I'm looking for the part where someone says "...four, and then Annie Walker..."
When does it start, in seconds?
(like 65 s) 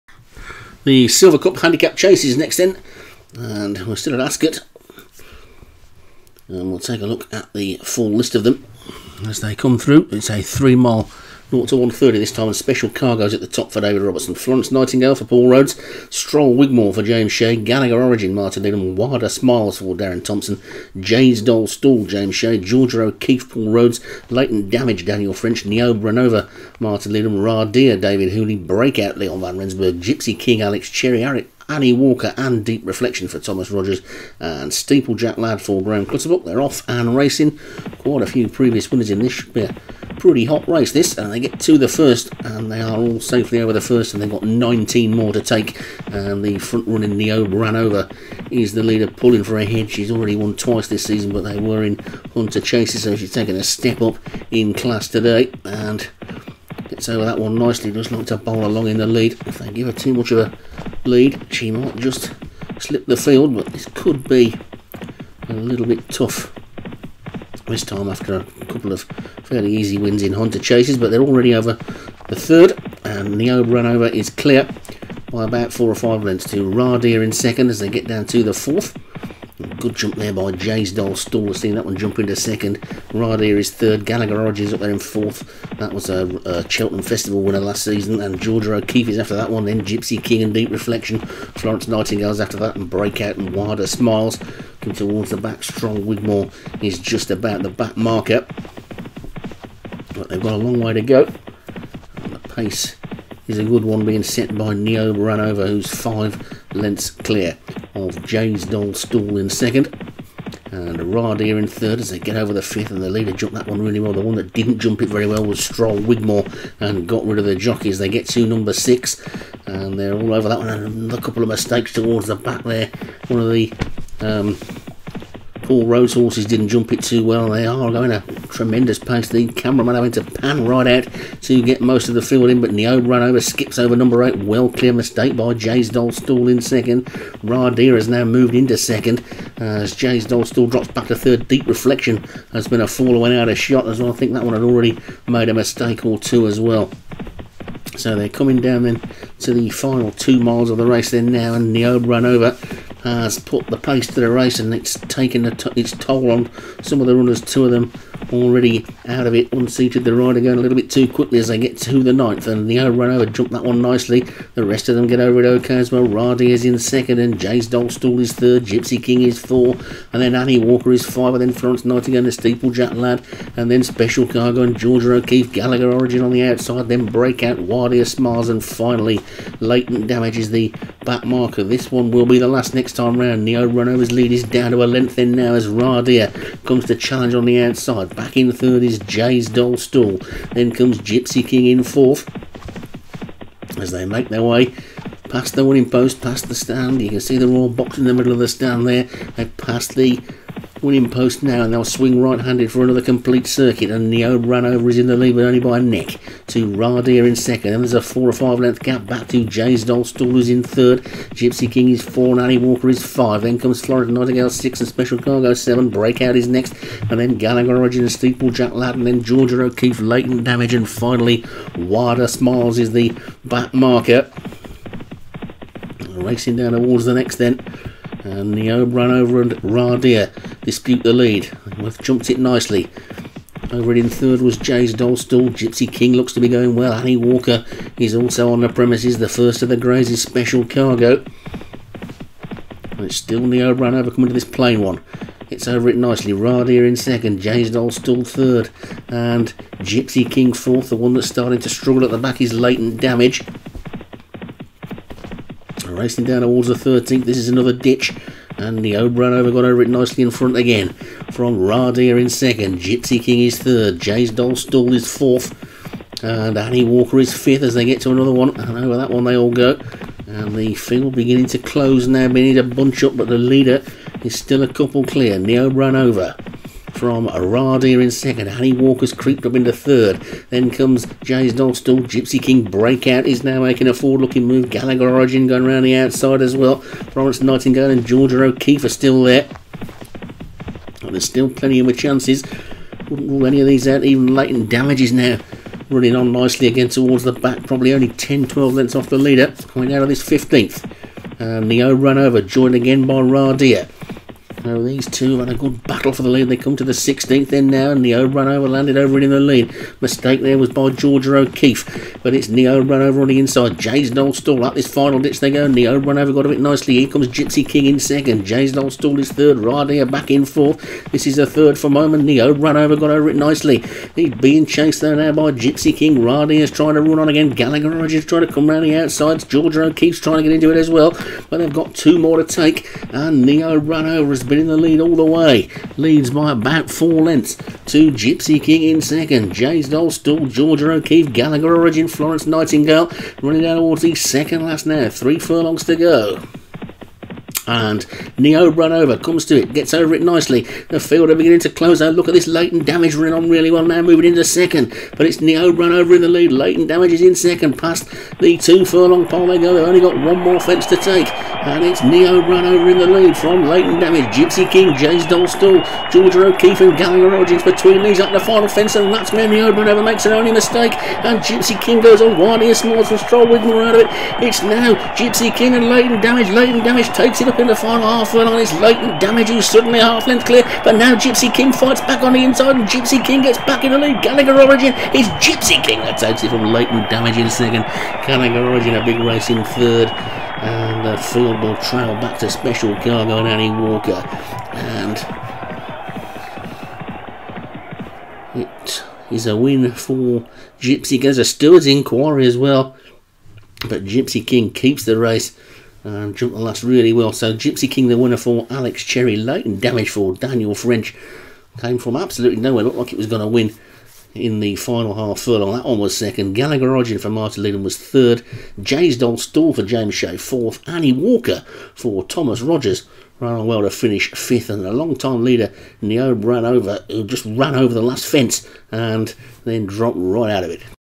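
169 s.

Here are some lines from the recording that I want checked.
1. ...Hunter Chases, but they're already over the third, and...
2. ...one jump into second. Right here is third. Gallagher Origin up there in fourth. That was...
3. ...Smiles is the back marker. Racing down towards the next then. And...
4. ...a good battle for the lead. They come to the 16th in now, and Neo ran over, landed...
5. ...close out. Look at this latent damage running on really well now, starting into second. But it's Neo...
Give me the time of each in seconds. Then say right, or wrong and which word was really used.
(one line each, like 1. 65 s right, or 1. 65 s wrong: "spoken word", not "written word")
1. 70 s right
2. 81 s right
3. 222 s right
4. 305 s right
5. 351 s wrong: "moving", not "starting".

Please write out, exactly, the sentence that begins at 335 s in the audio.
Leads by about four lengths to Gypsy King in second.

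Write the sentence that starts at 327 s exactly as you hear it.
Gallagher Origin trying to come round the outside.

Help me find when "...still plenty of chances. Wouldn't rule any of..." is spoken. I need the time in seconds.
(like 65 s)
291 s.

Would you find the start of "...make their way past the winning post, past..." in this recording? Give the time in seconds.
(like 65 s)
194 s.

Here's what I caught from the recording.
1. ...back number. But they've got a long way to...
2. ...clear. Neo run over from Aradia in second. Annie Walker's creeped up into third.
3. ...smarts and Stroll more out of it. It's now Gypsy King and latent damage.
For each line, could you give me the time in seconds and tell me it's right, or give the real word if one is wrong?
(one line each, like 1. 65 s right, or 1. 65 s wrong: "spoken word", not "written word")
1. 97 s wrong: "marker", not "number"
2. 275 s right
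3. 372 s right.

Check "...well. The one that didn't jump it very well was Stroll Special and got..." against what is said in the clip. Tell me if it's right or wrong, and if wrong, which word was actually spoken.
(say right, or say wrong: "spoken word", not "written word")
wrong: "Wigmore", not "Special".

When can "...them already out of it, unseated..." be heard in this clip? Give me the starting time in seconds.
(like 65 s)
157 s.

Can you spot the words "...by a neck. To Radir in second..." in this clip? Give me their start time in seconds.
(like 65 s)
205 s.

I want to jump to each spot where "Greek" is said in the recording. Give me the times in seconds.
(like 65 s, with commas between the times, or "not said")
not said.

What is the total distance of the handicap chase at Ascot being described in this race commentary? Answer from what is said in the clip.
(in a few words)
3 miles.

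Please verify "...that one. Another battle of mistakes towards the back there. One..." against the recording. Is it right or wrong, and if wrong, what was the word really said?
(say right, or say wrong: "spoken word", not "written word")
wrong: "couple", not "battle".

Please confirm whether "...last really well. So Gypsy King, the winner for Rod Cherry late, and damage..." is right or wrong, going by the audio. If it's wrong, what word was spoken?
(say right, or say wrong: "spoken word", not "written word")
wrong: "Alex", not "Rod".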